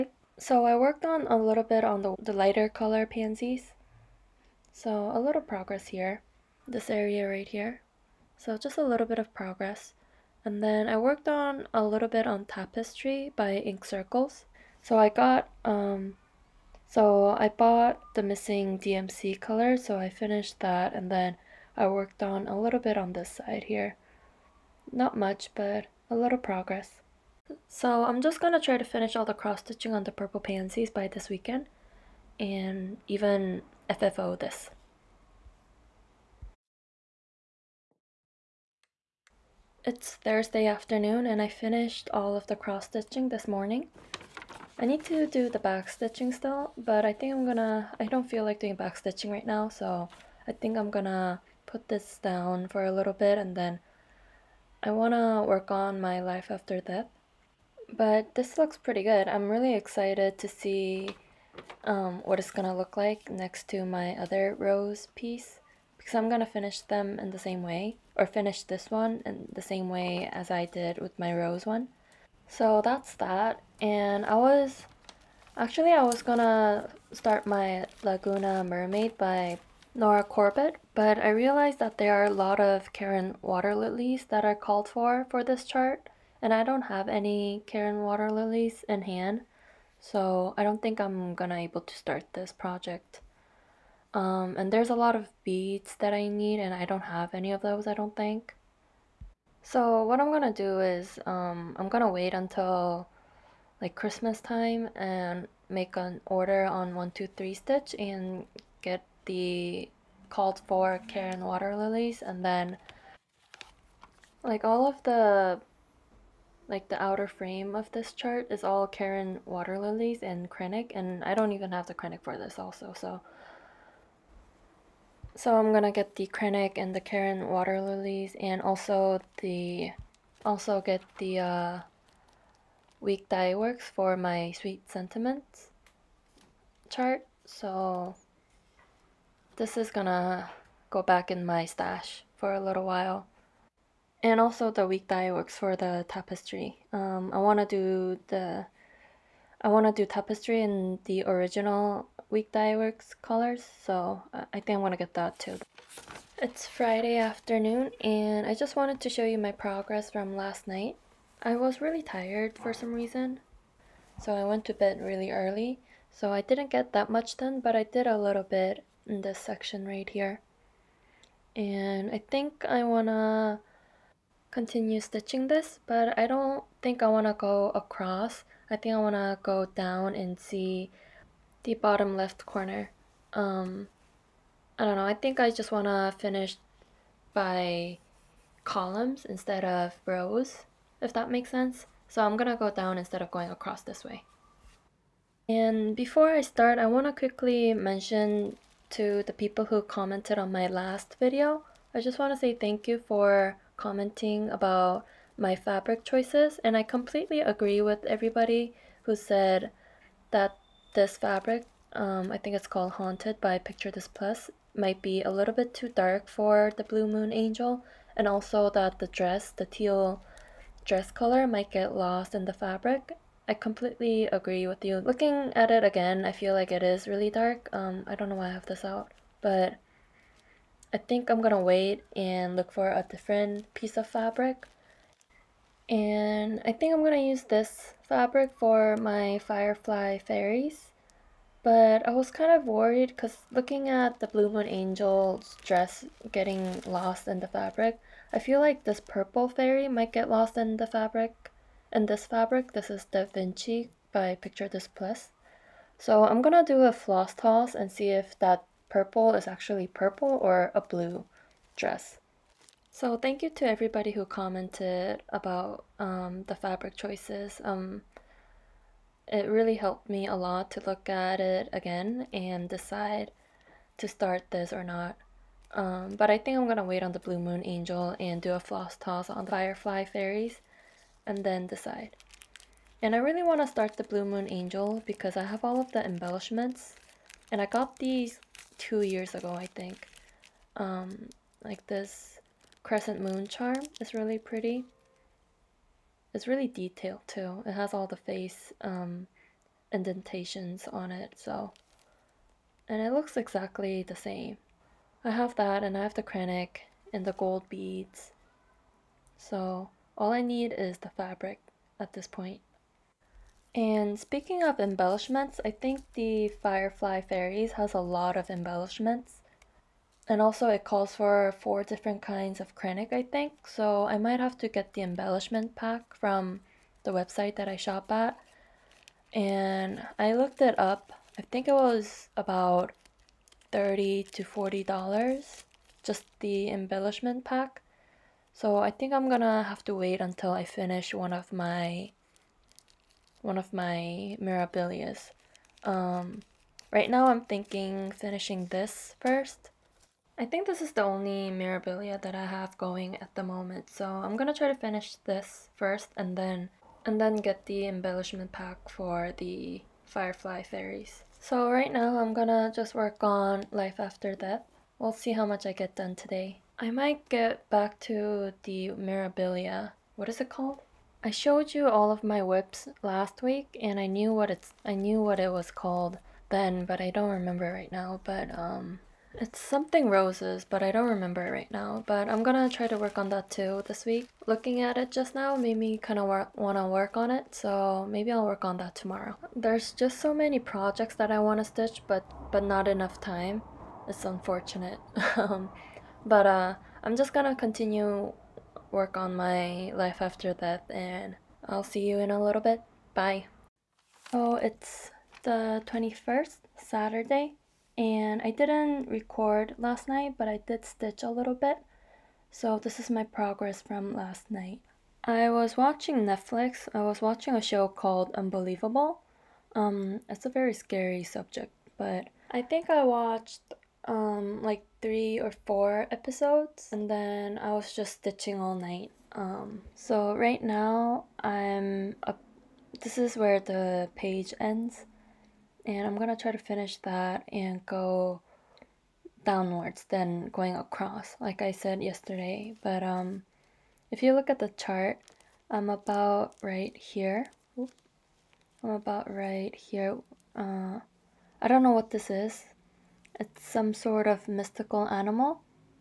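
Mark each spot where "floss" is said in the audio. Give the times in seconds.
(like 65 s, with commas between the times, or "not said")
256 s, 278 s.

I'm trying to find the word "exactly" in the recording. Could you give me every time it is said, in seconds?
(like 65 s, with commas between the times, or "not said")
303 s.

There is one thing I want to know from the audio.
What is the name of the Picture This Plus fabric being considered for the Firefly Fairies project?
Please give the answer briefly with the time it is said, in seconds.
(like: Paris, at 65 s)
Da Vinci, at 253 s.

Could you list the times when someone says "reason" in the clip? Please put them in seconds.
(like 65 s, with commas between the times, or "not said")
162 s.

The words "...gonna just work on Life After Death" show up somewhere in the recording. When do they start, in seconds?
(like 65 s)
362 s.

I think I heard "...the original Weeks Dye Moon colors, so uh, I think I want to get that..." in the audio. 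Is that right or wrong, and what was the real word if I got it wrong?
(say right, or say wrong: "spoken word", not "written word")
wrong: "Works", not "Moon".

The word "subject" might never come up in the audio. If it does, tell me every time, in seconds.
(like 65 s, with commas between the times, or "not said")
421 s.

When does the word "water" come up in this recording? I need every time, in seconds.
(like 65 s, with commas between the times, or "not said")
83 s, 88 s, 111 s, 119 s, 127 s.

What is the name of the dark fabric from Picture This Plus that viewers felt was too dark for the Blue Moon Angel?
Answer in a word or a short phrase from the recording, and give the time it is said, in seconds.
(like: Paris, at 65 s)
Haunted, at 212 s.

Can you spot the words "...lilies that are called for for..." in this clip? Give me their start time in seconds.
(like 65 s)
83 s.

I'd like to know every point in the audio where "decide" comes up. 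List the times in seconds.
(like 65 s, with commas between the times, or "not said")
272 s, 281 s.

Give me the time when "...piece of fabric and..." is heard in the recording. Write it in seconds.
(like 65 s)
233 s.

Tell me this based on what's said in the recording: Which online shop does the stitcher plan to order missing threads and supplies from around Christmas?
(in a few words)
123 Stitch.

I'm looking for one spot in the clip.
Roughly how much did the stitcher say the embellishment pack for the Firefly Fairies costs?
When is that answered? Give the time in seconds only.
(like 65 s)
333 s.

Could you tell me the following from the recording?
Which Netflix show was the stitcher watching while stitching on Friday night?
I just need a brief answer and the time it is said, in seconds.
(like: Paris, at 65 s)
Unbelievable, at 418 s.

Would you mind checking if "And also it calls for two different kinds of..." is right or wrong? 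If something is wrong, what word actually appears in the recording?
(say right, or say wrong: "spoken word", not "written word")
wrong: "four", not "two".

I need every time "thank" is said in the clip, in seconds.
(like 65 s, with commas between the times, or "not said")
202 s, 263 s.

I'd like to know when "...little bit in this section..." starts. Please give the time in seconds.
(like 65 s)
168 s.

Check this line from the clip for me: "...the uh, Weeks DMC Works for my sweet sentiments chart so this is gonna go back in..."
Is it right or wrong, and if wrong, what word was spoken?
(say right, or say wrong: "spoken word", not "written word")
wrong: "Dye", not "DMC".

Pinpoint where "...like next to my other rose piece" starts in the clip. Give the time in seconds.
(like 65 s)
62 s.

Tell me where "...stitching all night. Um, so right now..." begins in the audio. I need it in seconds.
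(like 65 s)
428 s.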